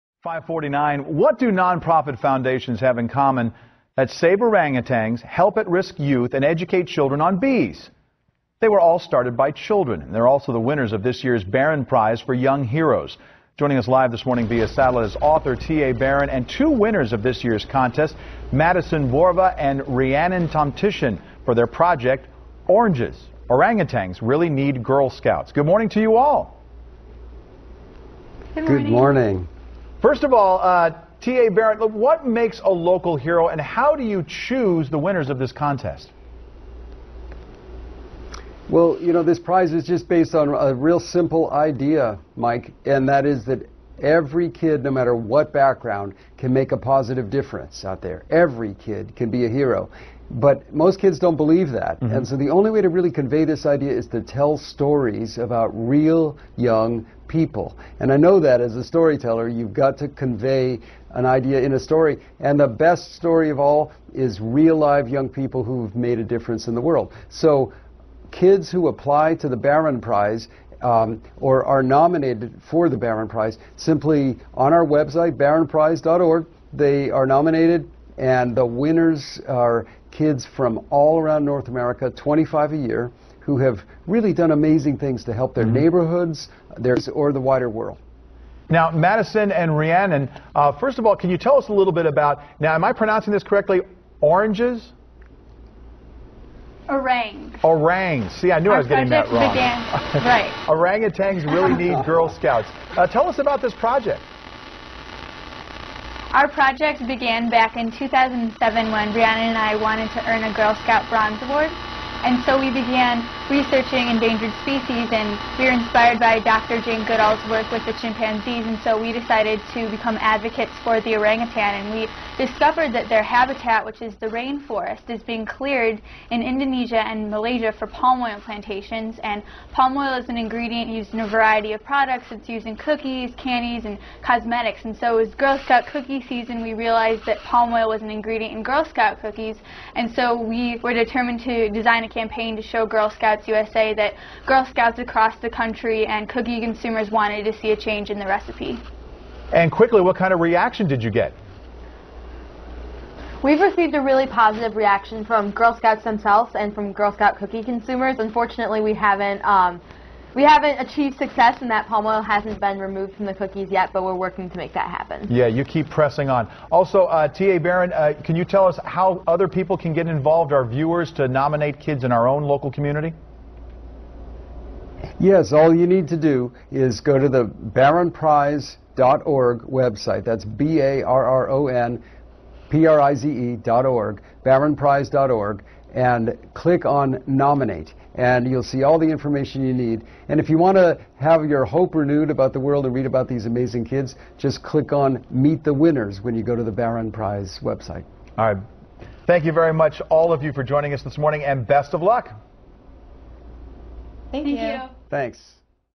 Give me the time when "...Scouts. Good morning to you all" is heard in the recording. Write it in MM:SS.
00:25.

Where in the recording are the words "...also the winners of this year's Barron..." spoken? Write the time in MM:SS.
00:10.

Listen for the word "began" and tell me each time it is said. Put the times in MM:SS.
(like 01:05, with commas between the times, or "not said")
01:39, 01:47, 01:52.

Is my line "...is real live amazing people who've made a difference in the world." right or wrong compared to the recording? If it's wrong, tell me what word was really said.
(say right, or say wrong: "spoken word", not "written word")
wrong: "young", not "amazing".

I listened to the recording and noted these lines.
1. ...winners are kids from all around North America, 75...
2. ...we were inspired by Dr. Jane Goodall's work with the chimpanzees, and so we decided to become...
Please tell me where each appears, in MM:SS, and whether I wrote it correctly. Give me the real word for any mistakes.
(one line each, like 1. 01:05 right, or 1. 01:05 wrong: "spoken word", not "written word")
1. 01:18 wrong: "25", not "75"
2. 01:55 right.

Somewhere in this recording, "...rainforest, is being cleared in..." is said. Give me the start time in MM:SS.
02:04.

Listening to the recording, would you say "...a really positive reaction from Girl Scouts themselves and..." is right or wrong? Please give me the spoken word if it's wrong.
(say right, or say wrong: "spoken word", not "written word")
right.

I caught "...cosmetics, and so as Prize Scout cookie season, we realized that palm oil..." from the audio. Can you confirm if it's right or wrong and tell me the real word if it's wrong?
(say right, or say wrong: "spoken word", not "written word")
wrong: "Girl", not "Prize".